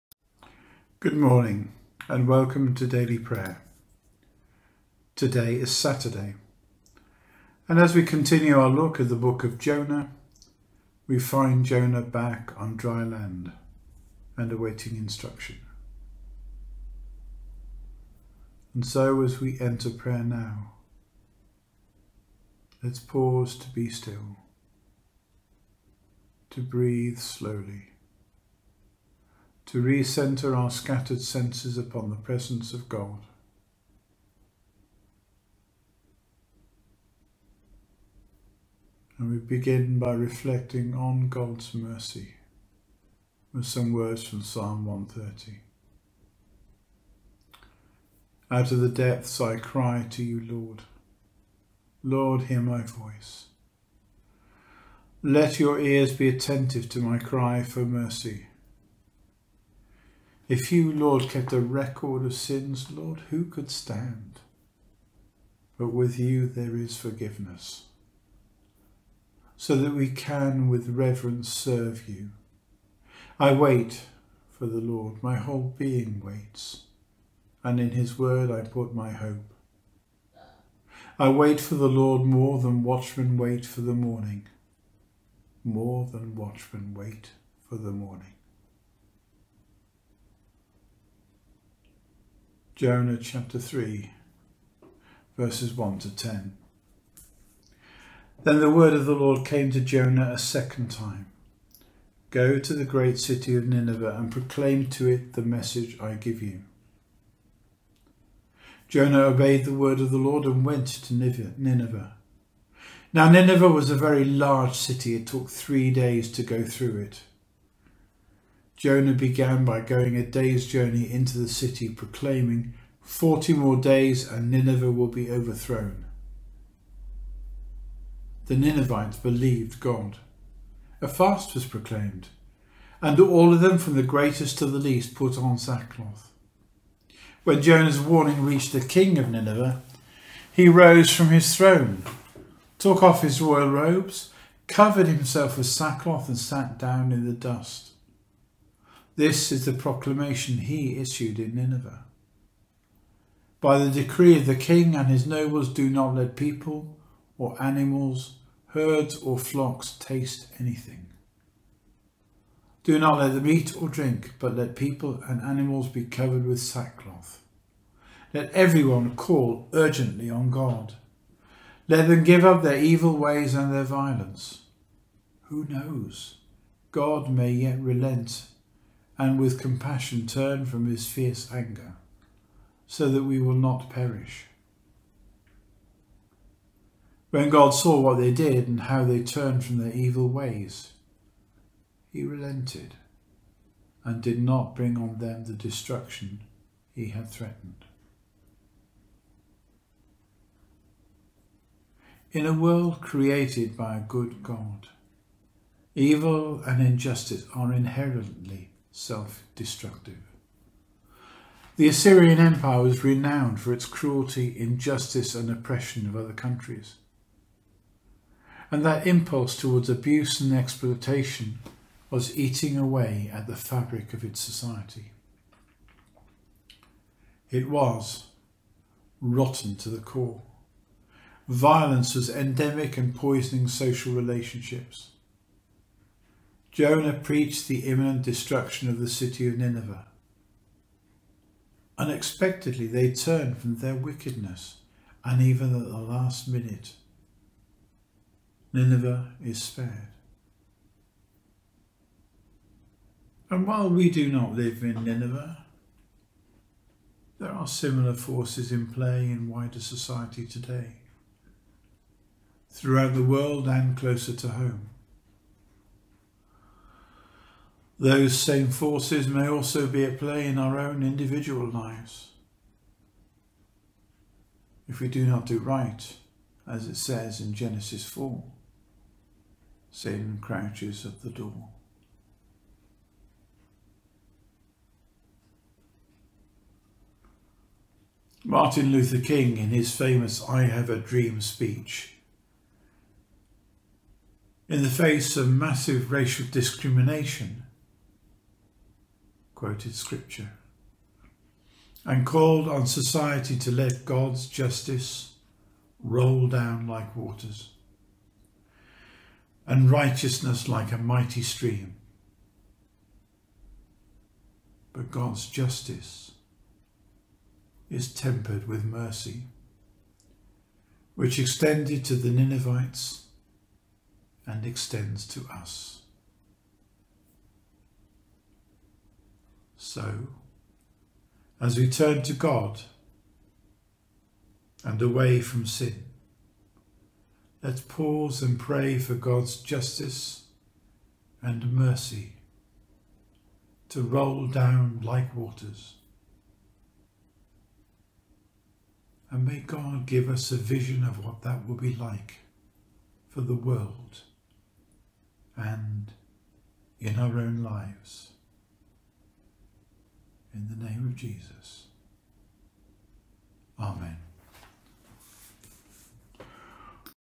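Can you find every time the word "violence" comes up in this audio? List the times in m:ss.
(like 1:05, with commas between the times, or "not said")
2:53, 3:51.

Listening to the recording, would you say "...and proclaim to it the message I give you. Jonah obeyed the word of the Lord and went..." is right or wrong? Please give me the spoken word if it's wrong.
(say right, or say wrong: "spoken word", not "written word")
right.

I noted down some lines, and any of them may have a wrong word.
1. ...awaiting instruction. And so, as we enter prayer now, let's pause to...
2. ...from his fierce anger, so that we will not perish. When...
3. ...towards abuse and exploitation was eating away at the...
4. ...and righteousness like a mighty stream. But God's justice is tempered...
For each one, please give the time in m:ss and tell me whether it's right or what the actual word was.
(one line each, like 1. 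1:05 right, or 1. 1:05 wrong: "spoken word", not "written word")
1. 0:14 right
2. 3:00 right
3. 3:39 right
4. 5:09 right.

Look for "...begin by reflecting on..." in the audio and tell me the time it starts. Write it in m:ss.
0:39.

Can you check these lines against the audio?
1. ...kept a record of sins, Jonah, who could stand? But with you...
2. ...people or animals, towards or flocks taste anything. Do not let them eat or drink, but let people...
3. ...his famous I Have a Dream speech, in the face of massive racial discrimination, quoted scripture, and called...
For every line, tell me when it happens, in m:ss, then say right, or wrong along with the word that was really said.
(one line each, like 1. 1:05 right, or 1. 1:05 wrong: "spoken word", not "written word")
1. 1:01 wrong: "Lord", not "Jonah"
2. 2:36 wrong: "herds", not "towards"
3. 4:49 right.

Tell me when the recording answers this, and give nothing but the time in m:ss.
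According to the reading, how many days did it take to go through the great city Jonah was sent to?
1:55.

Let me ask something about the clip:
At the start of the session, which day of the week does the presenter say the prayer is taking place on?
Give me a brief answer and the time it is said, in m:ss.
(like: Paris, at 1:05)
Saturday, at 0:05.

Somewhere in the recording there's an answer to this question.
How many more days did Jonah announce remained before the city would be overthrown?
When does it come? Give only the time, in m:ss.
2:02.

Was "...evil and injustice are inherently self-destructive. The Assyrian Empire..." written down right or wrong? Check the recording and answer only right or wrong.
right.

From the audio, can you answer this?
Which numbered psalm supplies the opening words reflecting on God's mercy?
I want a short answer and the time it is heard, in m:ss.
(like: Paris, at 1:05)
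Psalm 130, at 0:44.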